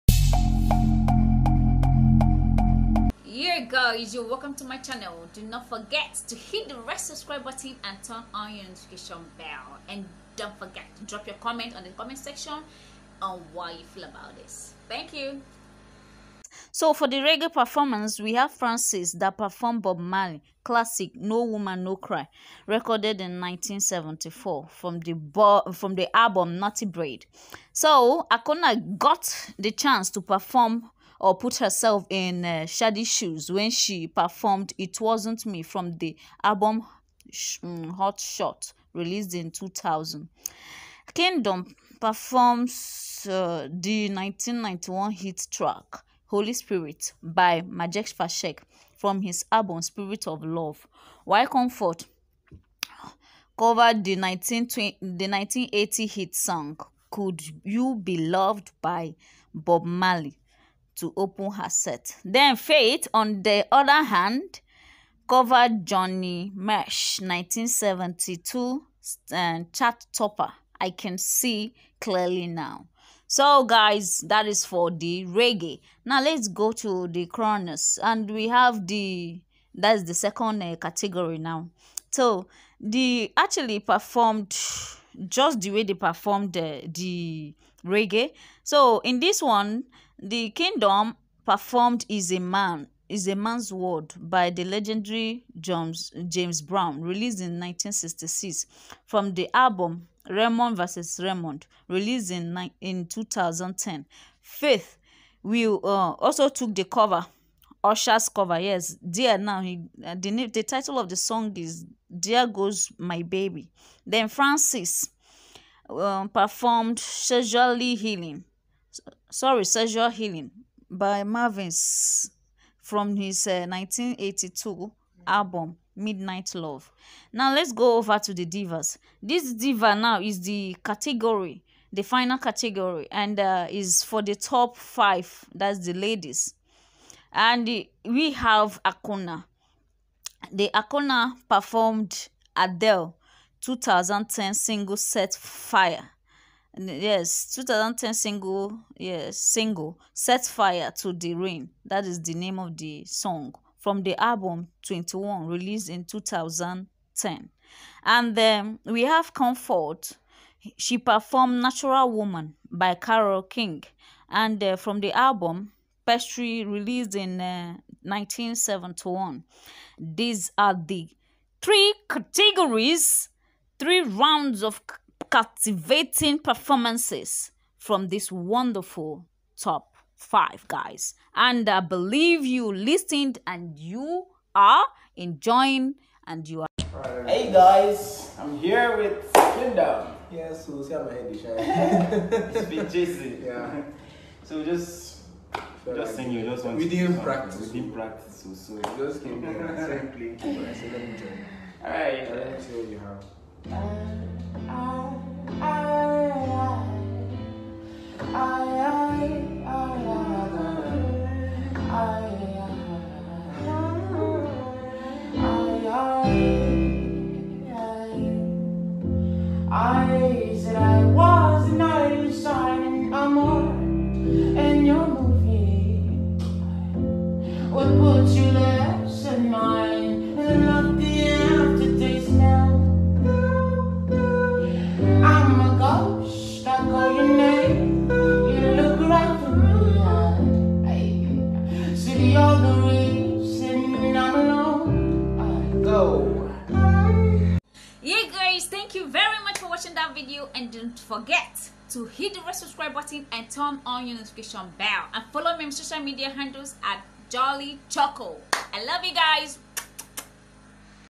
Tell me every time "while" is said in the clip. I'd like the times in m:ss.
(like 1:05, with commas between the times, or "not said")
0:51.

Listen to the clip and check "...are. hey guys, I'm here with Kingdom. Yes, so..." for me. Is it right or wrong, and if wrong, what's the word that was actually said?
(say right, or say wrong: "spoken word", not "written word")
right.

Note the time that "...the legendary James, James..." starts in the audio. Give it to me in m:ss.
1:34.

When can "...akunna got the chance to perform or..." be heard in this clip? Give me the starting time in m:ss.
0:28.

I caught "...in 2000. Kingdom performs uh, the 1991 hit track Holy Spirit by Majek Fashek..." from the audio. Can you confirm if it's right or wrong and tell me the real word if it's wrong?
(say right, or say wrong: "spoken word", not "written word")
right.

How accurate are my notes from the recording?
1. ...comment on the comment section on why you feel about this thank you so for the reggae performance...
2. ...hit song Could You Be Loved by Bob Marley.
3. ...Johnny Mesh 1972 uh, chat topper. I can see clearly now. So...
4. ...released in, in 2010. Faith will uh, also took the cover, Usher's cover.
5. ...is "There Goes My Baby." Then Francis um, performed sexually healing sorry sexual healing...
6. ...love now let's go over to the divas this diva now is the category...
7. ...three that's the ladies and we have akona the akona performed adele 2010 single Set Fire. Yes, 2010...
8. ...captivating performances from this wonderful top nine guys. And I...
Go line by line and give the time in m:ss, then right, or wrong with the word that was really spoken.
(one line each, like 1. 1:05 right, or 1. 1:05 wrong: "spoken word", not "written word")
1. 0:11 right
2. 0:56 right
3. 1:05 right
4. 1:41 right
5. 1:51 right
6. 2:06 right
7. 2:14 wrong: "five", not "three"
8. 2:55 wrong: "five", not "nine".